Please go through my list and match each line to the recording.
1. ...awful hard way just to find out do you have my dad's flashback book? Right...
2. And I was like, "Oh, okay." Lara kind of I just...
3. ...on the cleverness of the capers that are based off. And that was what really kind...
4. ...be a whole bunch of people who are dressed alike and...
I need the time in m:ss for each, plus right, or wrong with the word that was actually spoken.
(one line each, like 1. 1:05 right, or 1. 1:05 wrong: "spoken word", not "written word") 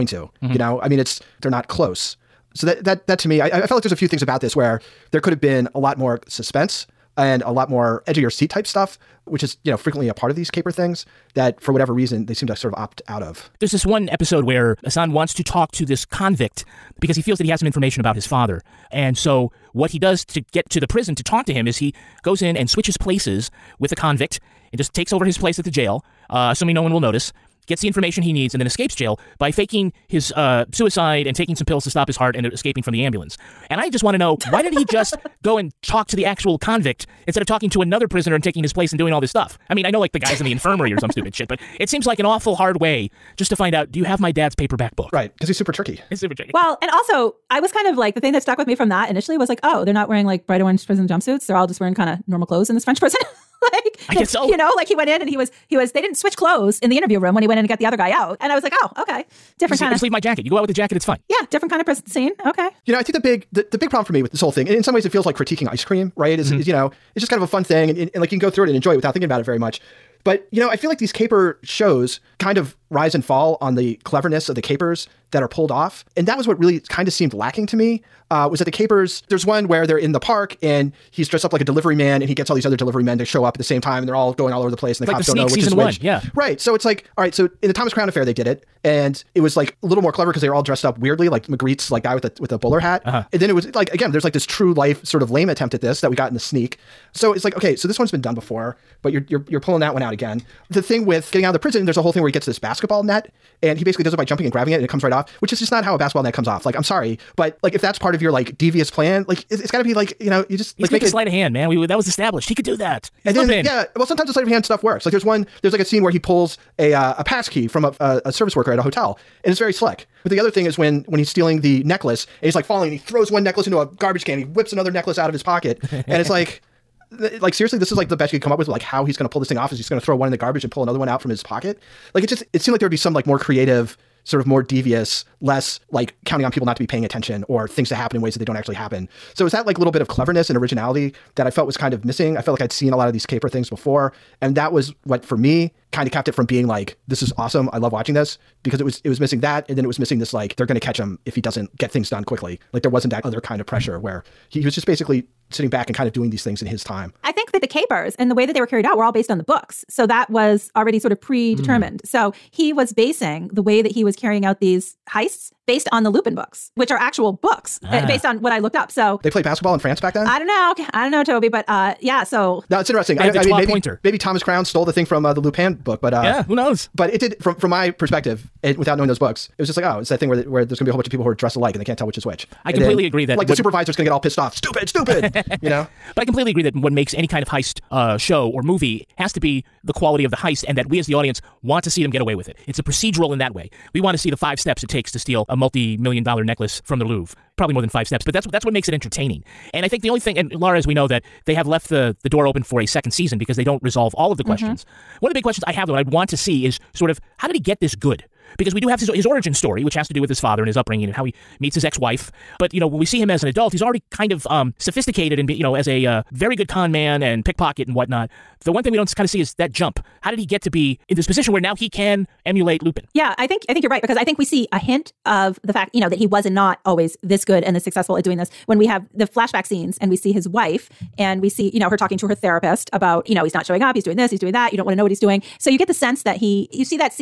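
1. 0:42 wrong: "paperback", not "flashback"
2. 0:58 wrong: "Different", not "Lara"
3. 1:13 wrong: "pulled", not "based"
4. 3:00 right.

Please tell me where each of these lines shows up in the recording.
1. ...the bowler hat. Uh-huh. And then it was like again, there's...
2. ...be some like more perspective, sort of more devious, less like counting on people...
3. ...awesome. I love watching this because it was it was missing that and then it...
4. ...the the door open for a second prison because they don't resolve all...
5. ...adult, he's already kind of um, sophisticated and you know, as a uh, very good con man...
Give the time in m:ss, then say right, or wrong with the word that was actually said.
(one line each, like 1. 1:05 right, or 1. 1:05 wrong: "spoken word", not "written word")
1. 1:32 right
2. 2:12 wrong: "creative", not "perspective"
3. 2:27 right
4. 3:21 wrong: "season", not "prison"
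5. 3:33 right.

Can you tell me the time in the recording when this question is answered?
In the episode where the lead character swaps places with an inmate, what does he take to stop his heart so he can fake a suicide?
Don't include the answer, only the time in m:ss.
0:31.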